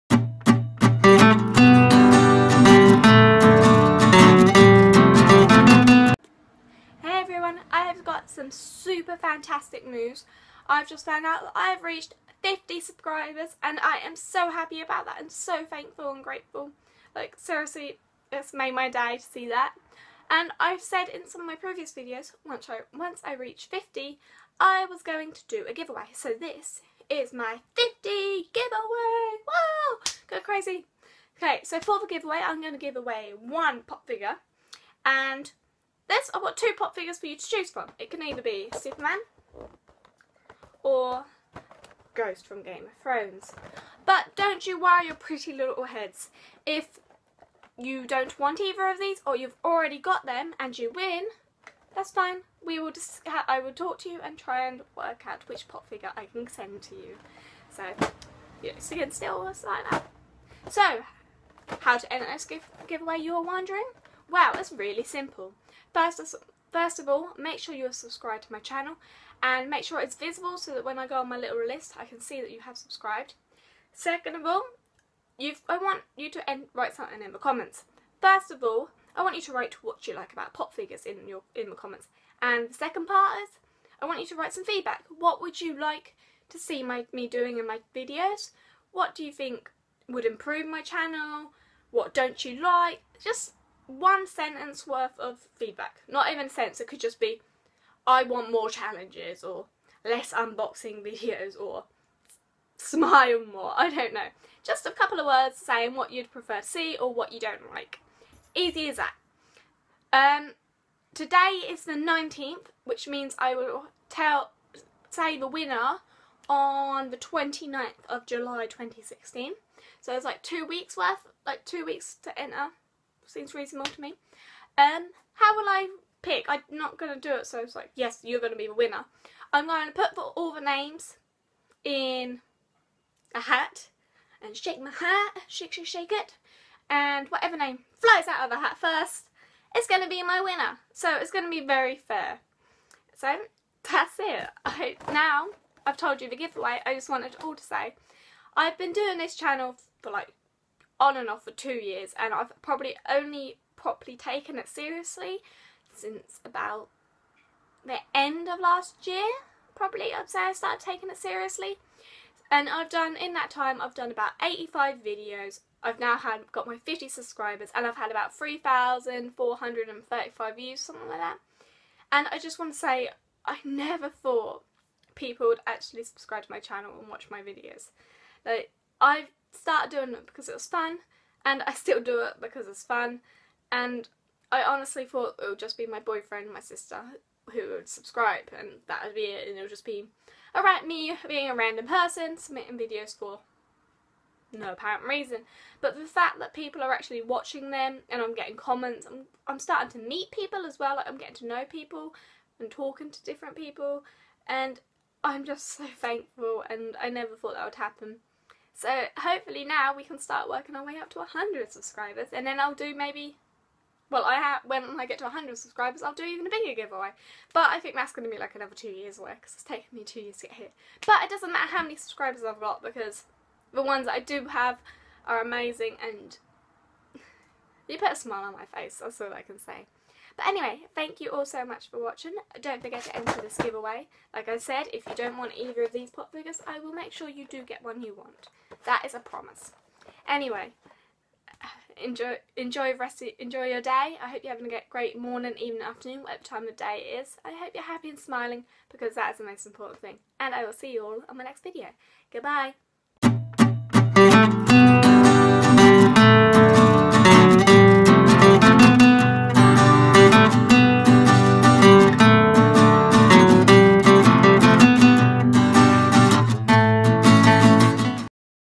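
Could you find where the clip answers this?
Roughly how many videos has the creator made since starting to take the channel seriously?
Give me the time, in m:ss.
2:44.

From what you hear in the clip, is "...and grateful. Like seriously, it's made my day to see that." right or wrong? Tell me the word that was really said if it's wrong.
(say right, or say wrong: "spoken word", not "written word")
right.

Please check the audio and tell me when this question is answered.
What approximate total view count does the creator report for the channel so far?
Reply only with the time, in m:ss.
2:48.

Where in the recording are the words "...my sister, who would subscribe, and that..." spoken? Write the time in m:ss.
3:06.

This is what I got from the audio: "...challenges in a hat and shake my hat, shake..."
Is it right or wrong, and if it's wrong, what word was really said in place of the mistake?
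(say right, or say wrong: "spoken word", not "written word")
wrong: "names", not "challenges".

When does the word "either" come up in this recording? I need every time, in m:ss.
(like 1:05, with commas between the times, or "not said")
0:38, 0:48, 3:55.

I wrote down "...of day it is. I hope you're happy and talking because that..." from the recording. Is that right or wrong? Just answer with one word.
wrong.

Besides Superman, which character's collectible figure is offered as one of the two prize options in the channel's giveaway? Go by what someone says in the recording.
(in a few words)
Ghost.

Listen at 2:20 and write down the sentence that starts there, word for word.
So it's going to be very fair.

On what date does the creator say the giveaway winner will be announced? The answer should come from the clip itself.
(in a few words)
29th of July 2016.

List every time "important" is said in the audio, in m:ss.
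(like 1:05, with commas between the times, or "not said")
4:09.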